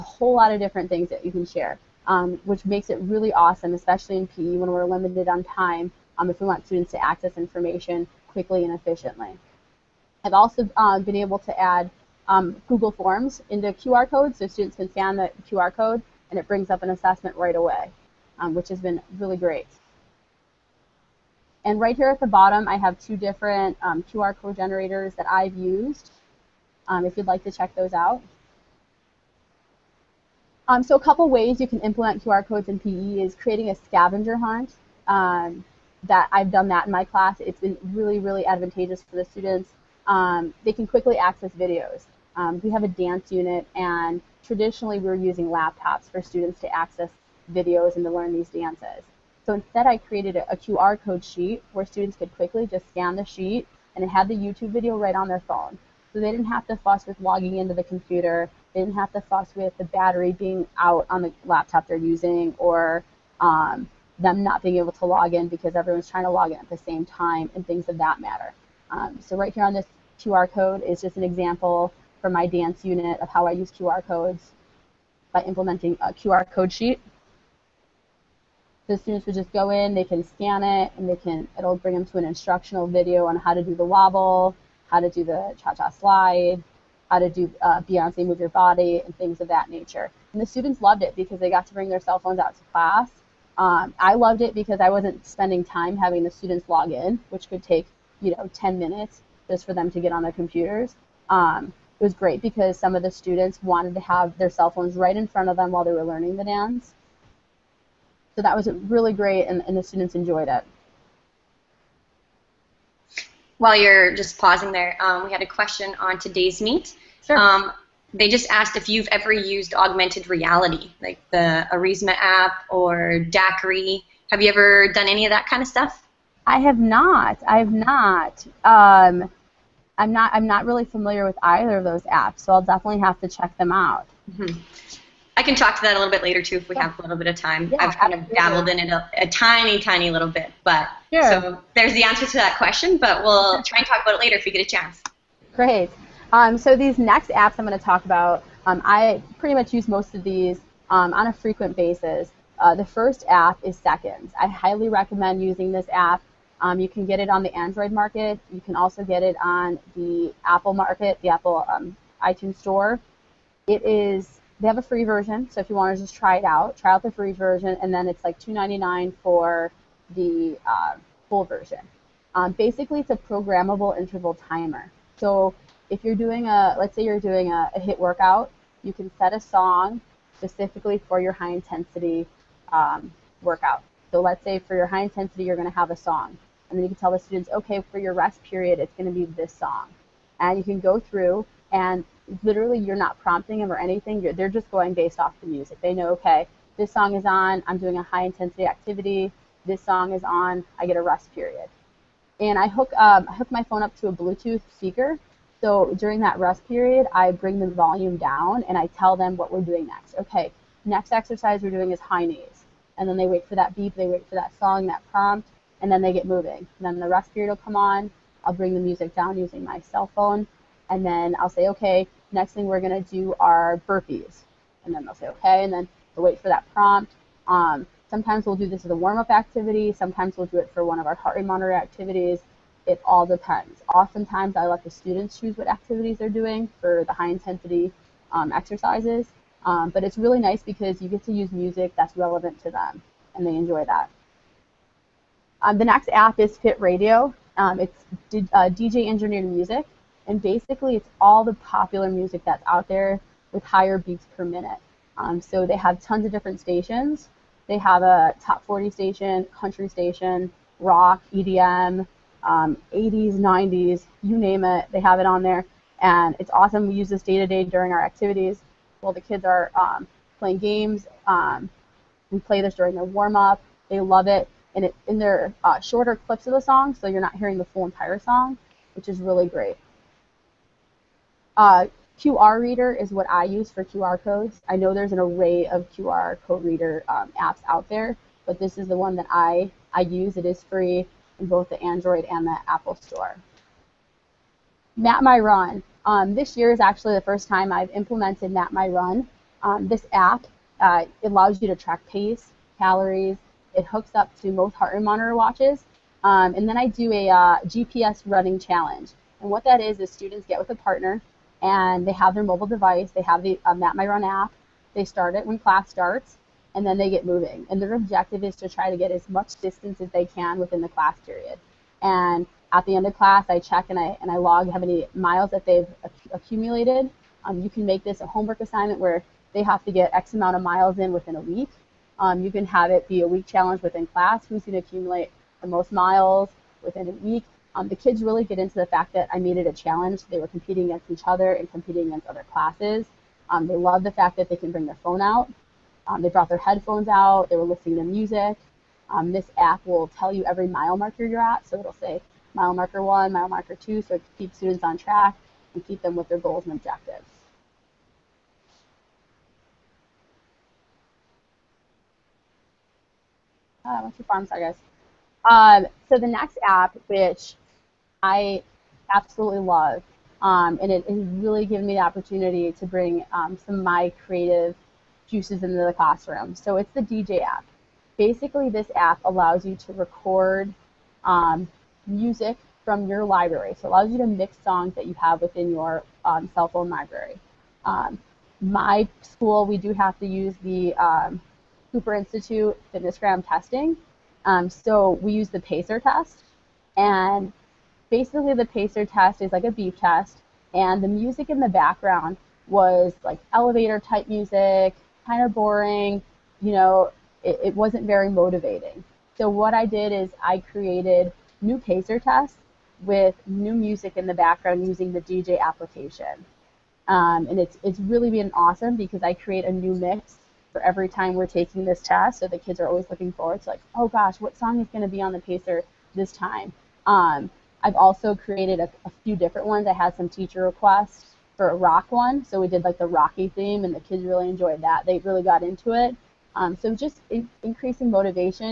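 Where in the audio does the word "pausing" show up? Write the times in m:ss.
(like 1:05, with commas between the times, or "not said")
1:54.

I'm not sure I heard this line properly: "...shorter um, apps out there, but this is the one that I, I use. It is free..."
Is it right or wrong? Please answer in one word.
wrong.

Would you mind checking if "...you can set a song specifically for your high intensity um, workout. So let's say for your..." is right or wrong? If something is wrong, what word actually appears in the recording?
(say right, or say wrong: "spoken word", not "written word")
right.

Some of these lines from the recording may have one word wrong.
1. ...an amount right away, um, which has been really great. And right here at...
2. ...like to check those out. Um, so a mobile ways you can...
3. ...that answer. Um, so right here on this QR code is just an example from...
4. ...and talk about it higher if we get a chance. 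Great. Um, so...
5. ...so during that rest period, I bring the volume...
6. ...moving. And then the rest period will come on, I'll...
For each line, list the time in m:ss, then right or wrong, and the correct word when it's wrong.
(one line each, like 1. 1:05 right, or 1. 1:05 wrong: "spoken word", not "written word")
1. 0:16 wrong: "assessment", not "amount"
2. 0:27 wrong: "couple", not "mobile"
3. 1:07 wrong: "matter", not "answer"
4. 2:23 wrong: "later", not "higher"
5. 3:25 right
6. 3:36 right.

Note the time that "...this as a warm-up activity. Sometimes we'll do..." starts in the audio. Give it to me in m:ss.
3:48.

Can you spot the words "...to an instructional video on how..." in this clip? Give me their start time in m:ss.
1:22.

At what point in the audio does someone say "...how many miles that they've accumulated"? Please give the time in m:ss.
5:24.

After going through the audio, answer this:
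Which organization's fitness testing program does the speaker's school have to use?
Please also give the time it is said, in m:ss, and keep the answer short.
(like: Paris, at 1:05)
Cooper Institute, at 6:31.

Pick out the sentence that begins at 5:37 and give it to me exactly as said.
Um, the kids really get into the fact that I made it a challenge.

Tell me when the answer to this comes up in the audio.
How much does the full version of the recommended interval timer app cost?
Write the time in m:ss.
2:48.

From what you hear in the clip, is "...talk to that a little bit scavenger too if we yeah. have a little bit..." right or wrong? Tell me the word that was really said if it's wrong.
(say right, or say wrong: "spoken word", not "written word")
wrong: "later", not "scavenger".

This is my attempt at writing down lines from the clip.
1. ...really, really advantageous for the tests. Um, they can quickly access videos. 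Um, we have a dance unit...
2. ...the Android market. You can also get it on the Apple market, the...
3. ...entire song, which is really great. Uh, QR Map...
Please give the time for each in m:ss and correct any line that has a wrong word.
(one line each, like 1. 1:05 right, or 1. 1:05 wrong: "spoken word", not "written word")
1. 0:37 wrong: "students", not "tests"
2. 2:37 right
3. 4:37 wrong: "Reader", not "Map".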